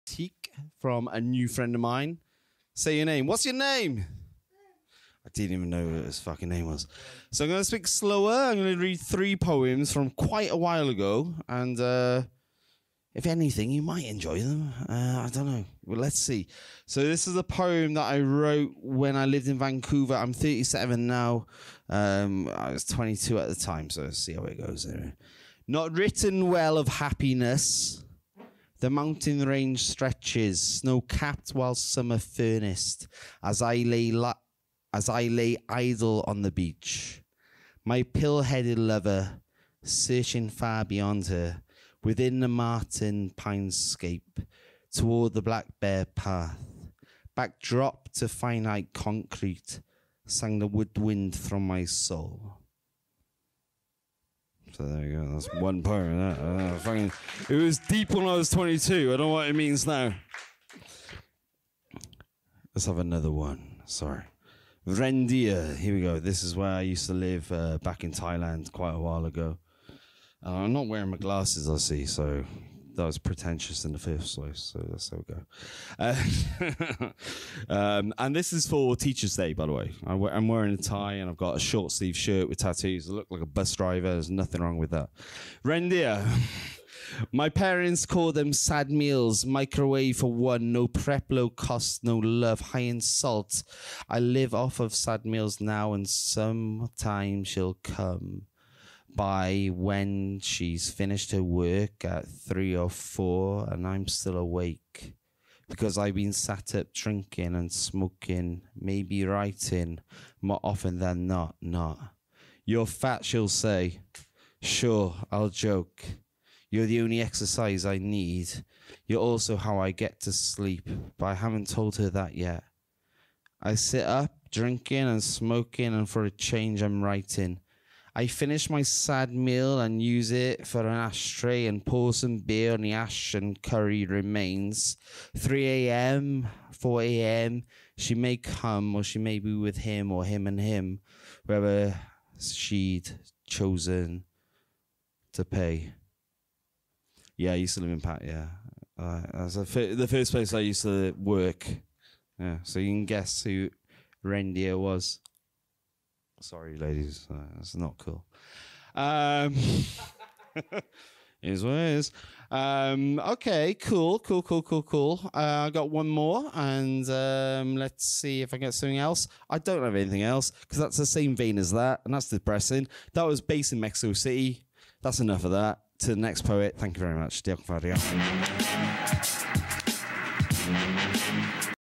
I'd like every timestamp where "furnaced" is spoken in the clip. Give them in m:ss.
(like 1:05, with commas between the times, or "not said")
0:32.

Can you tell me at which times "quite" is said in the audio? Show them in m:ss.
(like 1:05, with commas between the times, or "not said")
0:10, 1:08.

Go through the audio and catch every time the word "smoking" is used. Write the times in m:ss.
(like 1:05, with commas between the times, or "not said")
1:47, 2:05.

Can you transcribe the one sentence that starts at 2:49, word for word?
I don't have anything else because that's the same vein as that, and that's depressing.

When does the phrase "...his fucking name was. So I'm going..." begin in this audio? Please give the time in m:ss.
0:06.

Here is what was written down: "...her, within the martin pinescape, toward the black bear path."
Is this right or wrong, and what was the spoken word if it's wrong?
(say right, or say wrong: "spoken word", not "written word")
right.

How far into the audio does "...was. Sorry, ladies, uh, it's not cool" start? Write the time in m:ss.
2:34.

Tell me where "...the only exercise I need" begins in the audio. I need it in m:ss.
1:56.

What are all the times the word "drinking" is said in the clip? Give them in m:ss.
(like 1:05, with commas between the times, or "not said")
1:46, 2:04.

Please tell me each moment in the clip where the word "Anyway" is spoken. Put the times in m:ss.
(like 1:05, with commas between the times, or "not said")
0:24.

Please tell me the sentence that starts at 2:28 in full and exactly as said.
Uh, the first place I used to work.